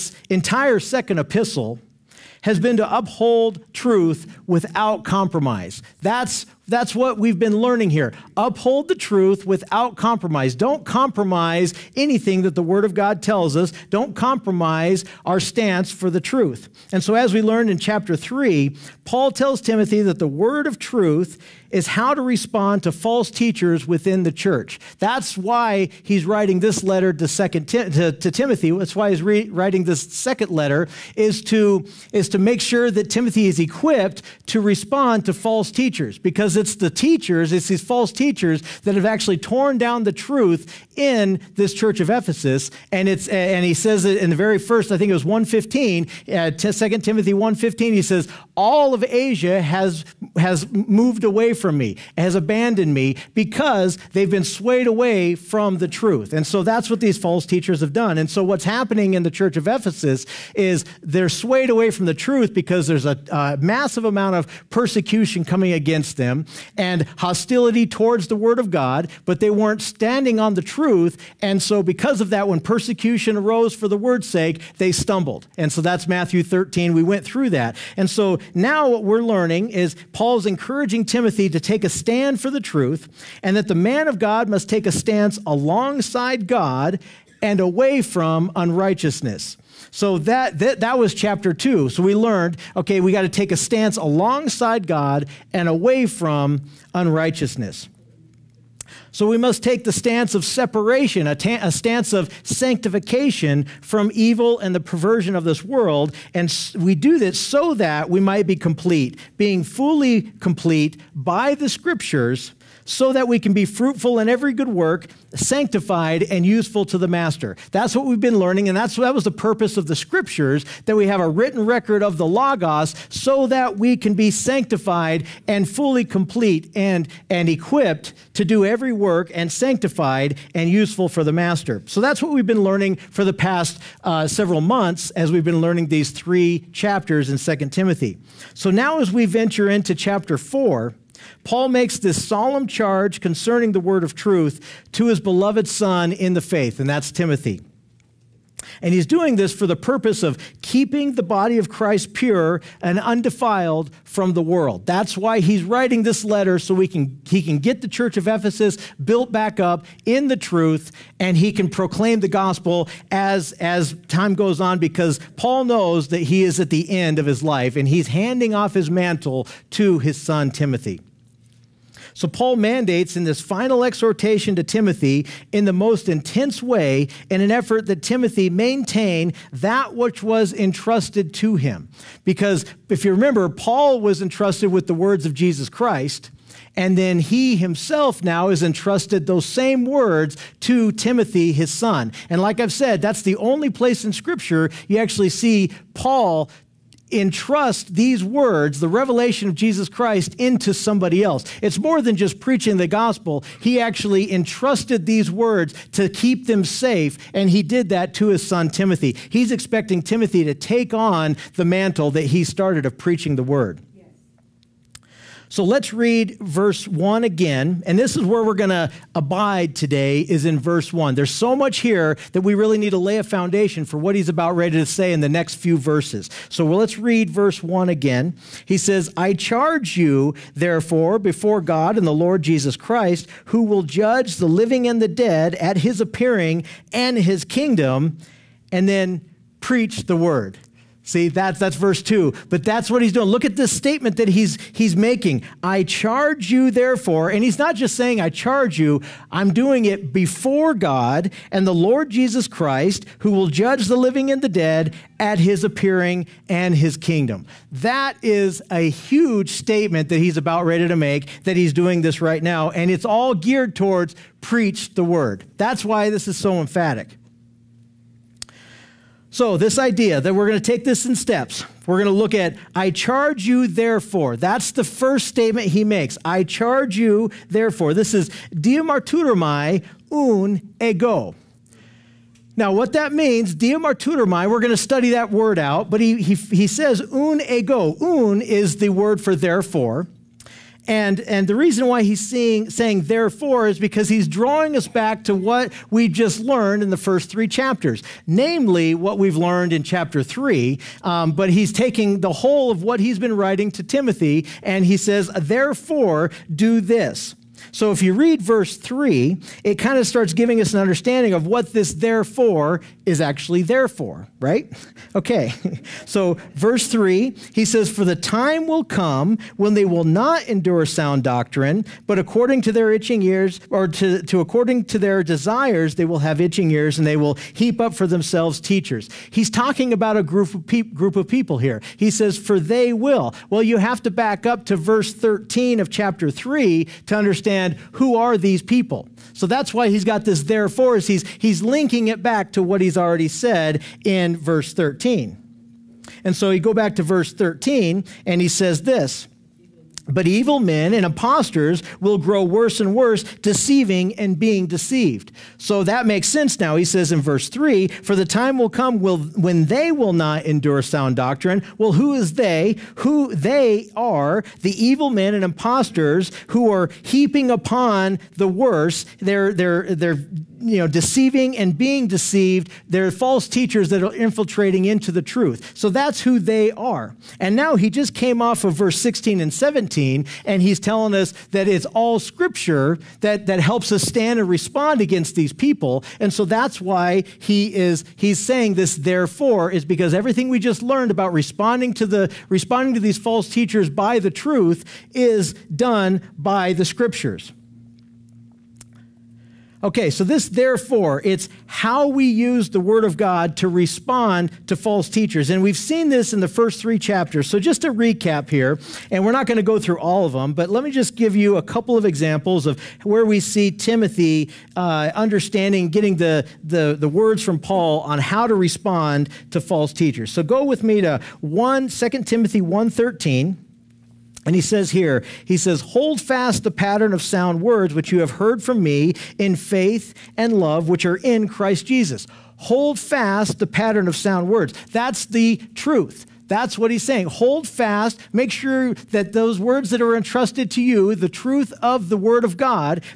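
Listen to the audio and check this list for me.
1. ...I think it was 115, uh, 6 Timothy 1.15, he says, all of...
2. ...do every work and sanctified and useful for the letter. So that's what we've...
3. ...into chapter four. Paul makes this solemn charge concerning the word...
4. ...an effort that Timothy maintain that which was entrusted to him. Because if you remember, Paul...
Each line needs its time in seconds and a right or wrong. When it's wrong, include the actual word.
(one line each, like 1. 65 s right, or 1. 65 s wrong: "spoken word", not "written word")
1. 44 s wrong: "2", not "6"
2. 128 s wrong: "master", not "letter"
3. 139 s right
4. 177 s right.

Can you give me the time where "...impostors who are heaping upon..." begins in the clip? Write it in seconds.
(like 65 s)
365 s.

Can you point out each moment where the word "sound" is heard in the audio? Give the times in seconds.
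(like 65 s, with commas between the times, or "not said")
320 s, 360 s, 427 s, 434 s.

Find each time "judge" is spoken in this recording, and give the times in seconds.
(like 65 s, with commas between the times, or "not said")
233 s, 253 s.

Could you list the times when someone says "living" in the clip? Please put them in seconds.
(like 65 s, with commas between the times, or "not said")
234 s, 253 s.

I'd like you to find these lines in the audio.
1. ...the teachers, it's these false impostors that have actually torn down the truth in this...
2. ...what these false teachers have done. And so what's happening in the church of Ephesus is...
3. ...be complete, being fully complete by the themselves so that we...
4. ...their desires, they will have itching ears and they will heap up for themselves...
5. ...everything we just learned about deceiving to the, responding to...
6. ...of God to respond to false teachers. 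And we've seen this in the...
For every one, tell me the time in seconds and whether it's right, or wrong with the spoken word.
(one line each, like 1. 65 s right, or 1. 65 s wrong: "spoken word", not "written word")
1. 36 s wrong: "teachers", not "impostors"
2. 56 s right
3. 108 s wrong: "scriptures", not "themselves"
4. 324 s right
5. 390 s wrong: "responding", not "deceiving"
6. 403 s right.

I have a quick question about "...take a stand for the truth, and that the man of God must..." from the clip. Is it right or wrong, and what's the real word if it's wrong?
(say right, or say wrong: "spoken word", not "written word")
right.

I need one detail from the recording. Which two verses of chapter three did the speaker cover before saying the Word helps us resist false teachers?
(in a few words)
16 and 17.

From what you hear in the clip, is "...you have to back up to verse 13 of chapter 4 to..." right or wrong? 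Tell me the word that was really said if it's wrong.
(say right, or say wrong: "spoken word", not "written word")
wrong: "3", not "4".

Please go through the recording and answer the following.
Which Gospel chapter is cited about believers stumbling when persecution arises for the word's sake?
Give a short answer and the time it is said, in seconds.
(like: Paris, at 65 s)
Matthew 13, at 76 s.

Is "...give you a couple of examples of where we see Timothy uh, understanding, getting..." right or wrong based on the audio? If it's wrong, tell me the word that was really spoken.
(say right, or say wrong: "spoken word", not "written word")
right.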